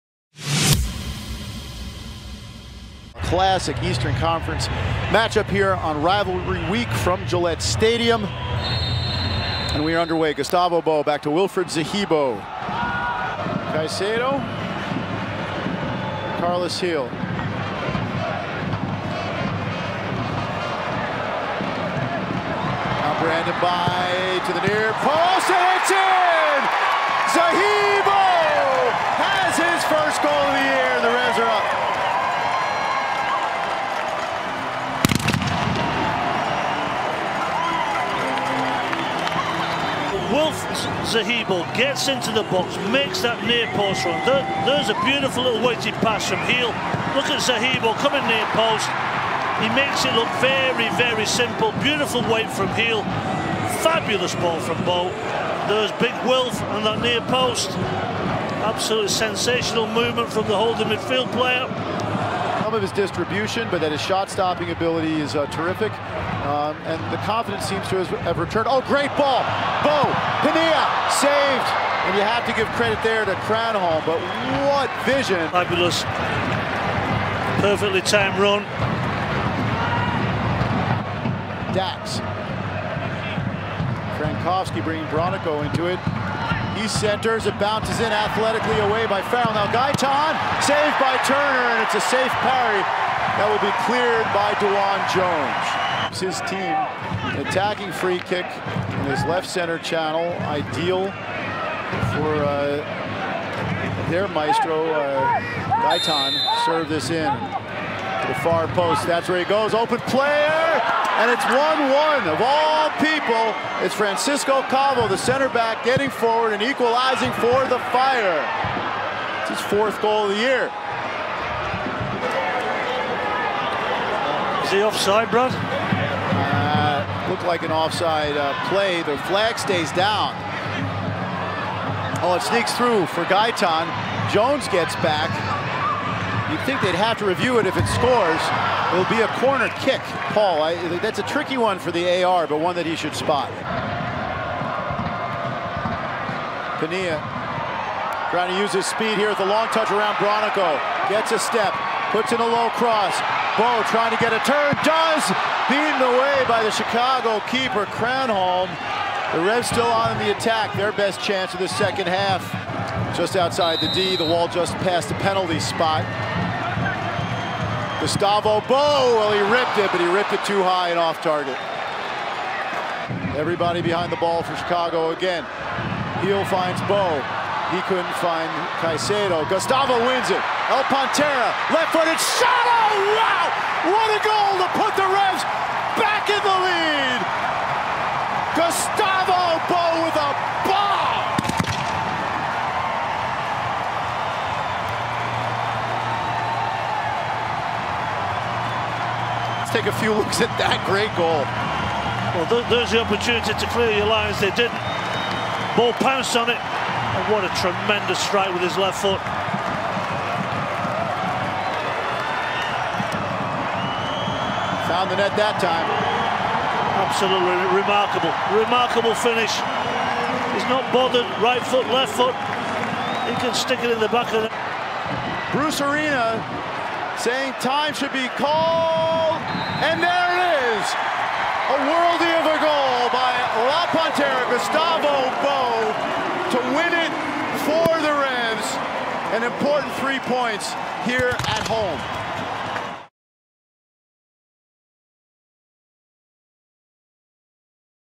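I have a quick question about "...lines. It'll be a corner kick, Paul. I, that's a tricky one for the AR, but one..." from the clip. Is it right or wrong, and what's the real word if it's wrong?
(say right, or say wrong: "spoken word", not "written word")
wrong: "scores", not "lines".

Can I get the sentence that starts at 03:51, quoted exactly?
A worldy of a goal by La Pantera, Gustavo Bou, to win it for the Rams.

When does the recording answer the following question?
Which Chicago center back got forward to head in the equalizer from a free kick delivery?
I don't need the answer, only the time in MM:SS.
01:53.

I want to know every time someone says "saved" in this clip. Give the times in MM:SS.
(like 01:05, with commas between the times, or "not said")
01:11, 01:30.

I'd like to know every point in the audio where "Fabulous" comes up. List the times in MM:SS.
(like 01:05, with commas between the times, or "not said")
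00:53, 01:15.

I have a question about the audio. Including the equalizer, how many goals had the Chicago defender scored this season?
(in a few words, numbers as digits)
4.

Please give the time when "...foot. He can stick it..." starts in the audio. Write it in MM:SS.
03:42.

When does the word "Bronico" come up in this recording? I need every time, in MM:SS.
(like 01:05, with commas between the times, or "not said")
01:25, 02:30.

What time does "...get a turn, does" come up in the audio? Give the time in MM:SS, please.
02:34.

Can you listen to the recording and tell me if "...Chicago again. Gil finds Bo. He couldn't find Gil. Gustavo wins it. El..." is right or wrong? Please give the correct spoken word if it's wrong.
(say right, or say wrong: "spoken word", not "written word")
wrong: "Caicedo", not "Gil".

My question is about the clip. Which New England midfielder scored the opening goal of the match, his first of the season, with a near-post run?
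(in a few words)
Wilfried Zahibo.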